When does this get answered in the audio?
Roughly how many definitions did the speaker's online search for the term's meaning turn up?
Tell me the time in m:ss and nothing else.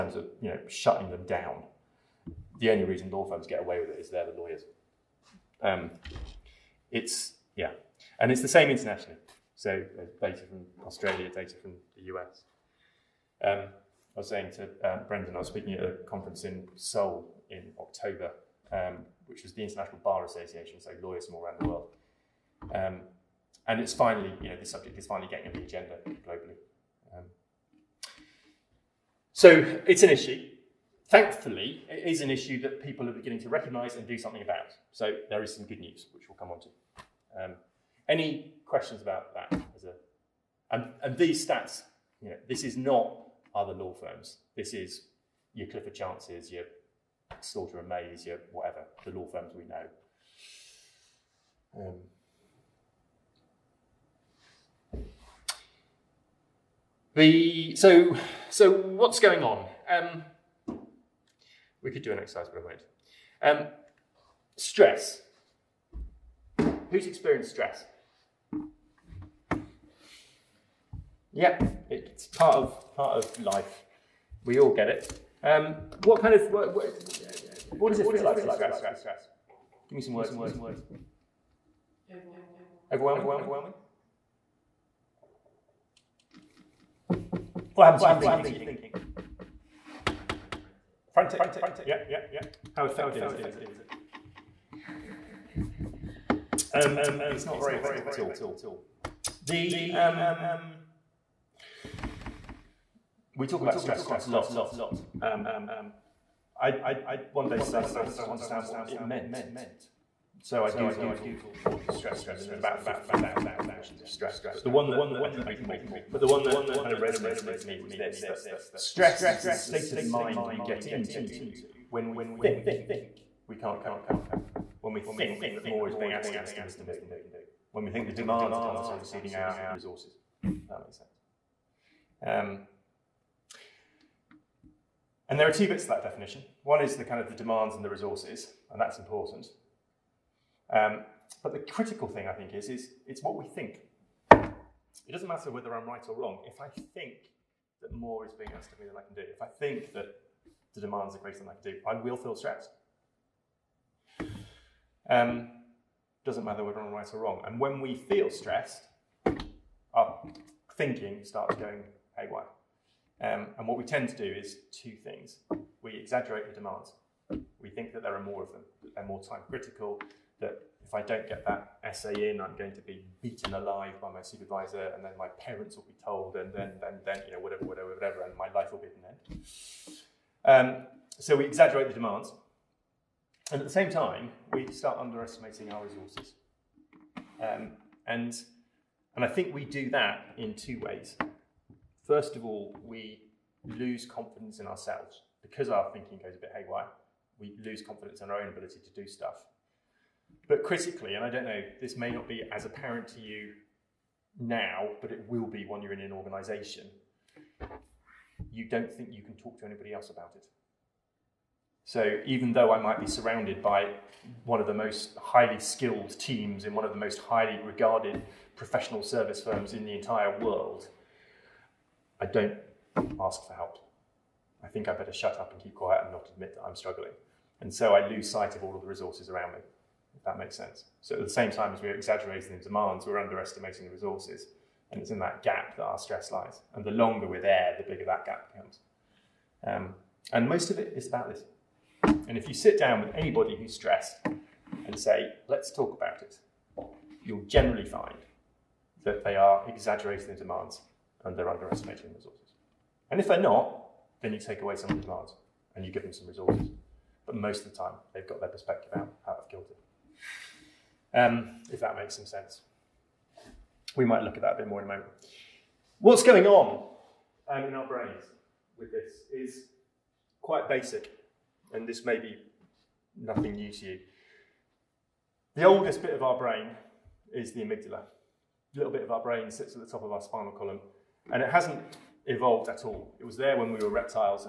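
1:52.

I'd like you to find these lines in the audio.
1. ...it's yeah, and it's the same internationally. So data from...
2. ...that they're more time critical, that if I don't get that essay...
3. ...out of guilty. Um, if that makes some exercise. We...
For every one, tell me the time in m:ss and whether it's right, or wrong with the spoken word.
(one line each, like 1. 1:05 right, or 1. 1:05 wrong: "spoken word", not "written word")
1. 0:06 right
2. 2:48 right
3. 4:19 wrong: "sense", not "exercise".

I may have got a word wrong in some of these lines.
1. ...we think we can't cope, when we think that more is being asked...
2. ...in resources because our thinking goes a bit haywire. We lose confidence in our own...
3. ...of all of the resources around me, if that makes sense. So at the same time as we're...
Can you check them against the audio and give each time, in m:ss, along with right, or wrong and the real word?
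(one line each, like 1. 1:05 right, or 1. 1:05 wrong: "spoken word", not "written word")
1. 2:02 right
2. 3:14 wrong: "ourselves", not "resources"
3. 3:48 right.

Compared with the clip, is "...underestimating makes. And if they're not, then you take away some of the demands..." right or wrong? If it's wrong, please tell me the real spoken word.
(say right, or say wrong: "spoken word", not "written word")
wrong: "resources", not "makes".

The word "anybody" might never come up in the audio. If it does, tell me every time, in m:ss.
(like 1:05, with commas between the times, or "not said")
3:29, 4:03.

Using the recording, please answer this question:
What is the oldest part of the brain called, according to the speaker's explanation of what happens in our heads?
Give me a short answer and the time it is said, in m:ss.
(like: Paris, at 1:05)
amygdala, at 4:37.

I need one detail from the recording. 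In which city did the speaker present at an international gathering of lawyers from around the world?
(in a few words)
Seoul.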